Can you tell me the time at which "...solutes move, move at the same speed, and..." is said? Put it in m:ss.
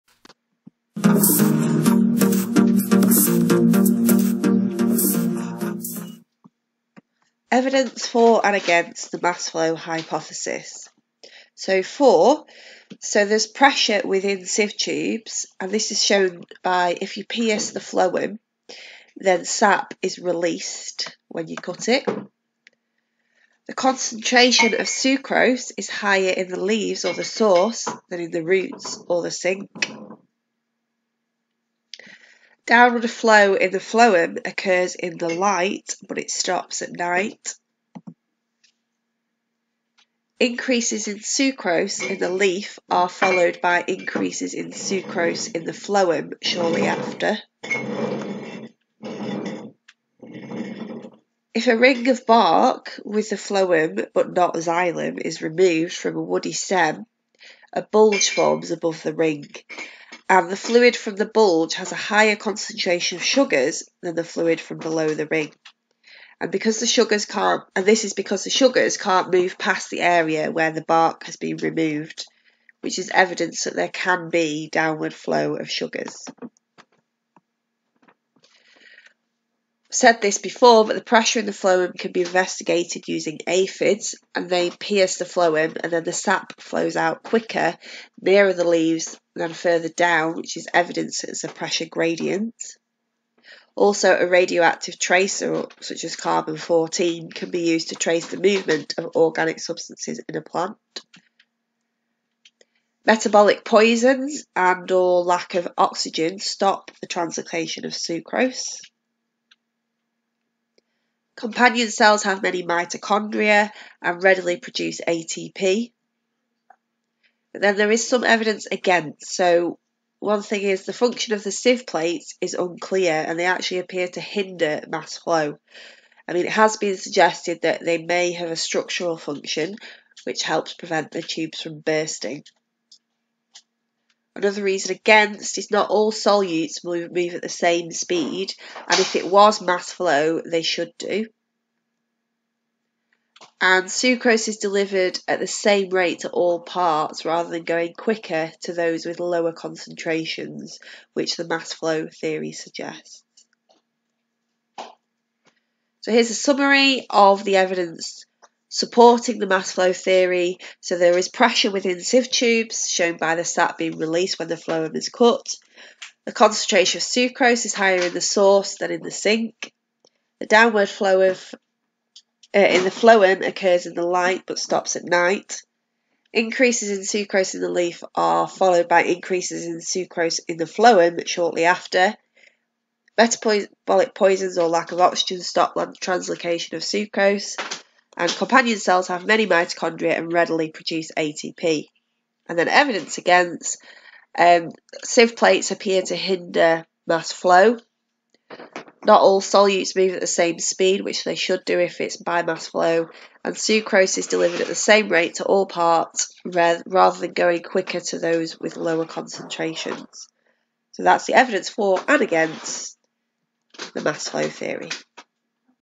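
2:16.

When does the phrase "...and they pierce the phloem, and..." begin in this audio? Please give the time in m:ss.
1:24.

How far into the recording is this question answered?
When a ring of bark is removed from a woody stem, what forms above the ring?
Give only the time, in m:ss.
0:57.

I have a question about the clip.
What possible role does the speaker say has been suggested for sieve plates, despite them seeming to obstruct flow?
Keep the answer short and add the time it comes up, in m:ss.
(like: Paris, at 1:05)
Structural function, at 2:08.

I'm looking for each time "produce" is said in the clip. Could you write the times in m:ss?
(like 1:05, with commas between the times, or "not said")
1:54, 3:10.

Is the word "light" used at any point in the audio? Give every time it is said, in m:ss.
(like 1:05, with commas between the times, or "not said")
0:35, 2:54.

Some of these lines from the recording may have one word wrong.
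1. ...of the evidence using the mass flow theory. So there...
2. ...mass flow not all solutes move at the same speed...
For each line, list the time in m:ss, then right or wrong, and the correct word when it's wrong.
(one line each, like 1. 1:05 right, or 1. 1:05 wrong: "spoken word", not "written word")
1. 2:37 wrong: "supporting", not "using"
2. 3:17 right.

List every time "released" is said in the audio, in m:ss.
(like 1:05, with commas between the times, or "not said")
0:20, 2:43.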